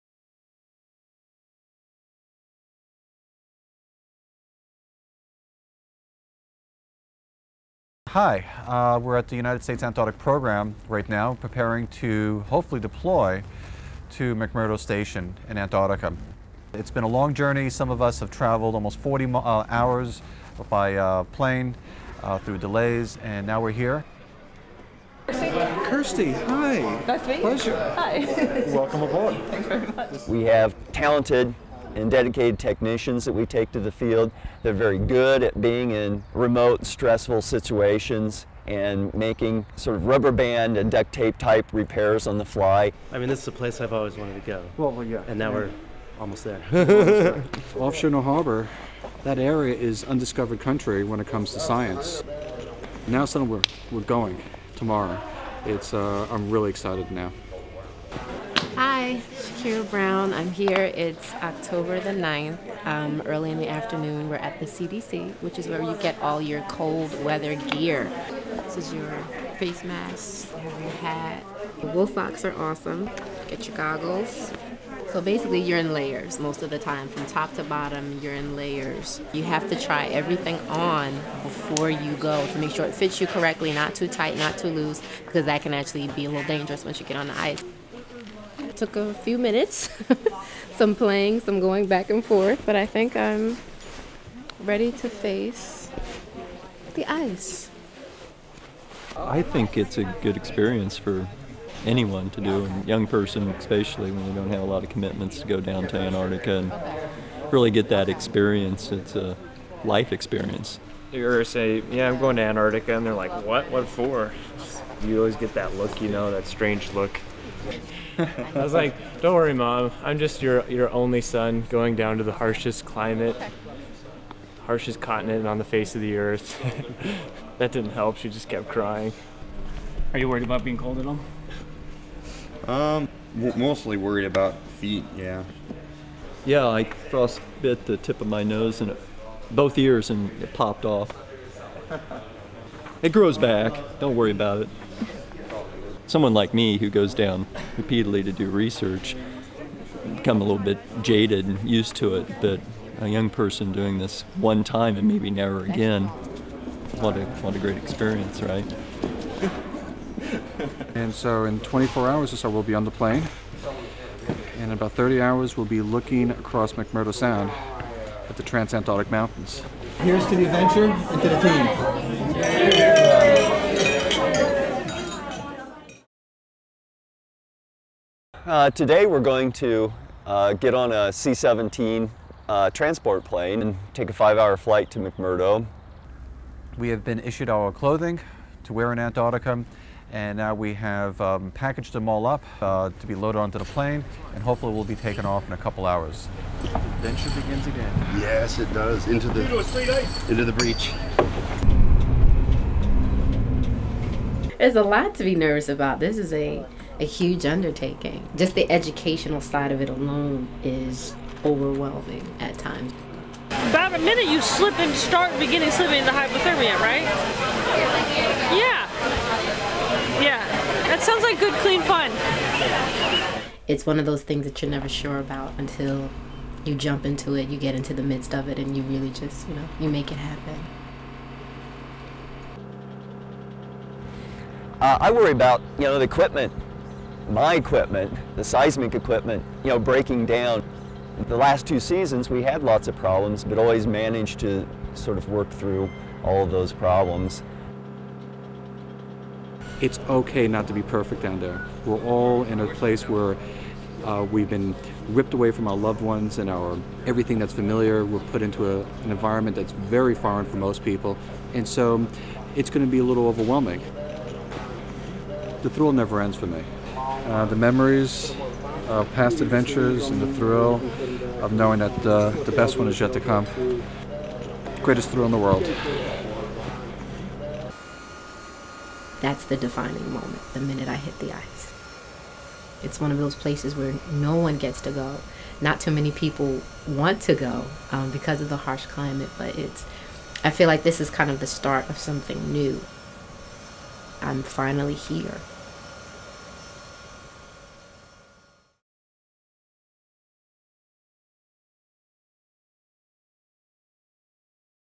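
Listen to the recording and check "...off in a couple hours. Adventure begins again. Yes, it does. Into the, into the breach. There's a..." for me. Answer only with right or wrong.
right.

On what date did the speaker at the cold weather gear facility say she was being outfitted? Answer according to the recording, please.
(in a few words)
October 9.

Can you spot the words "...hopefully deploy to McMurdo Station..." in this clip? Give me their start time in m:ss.
0:12.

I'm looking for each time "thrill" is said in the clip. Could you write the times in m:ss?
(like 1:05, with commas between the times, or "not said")
4:25, 4:30, 4:35.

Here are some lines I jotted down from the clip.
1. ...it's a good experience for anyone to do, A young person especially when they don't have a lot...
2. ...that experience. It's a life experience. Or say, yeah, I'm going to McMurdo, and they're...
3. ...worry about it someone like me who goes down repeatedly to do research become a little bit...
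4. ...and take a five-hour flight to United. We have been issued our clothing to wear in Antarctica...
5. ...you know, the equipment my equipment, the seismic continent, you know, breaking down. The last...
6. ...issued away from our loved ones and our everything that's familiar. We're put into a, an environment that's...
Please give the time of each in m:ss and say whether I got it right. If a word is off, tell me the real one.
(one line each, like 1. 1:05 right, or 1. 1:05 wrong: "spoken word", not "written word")
1. 1:39 right
2. 1:47 wrong: "Antarctica", not "McMurdo"
3. 2:24 right
4. 3:03 wrong: "McMurdo", not "United"
5. 3:55 wrong: "equipment", not "continent"
6. 4:15 wrong: "ripped", not "issued".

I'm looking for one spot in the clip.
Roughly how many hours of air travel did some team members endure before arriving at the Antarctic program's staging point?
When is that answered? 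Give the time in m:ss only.
0:18.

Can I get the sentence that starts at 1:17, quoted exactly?
From top to bottom, you're in layers.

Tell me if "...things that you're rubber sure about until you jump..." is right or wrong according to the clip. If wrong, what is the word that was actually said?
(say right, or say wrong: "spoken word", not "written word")
wrong: "never", not "rubber".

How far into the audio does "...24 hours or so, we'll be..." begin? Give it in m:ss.
2:41.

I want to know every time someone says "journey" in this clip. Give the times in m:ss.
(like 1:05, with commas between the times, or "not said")
0:17.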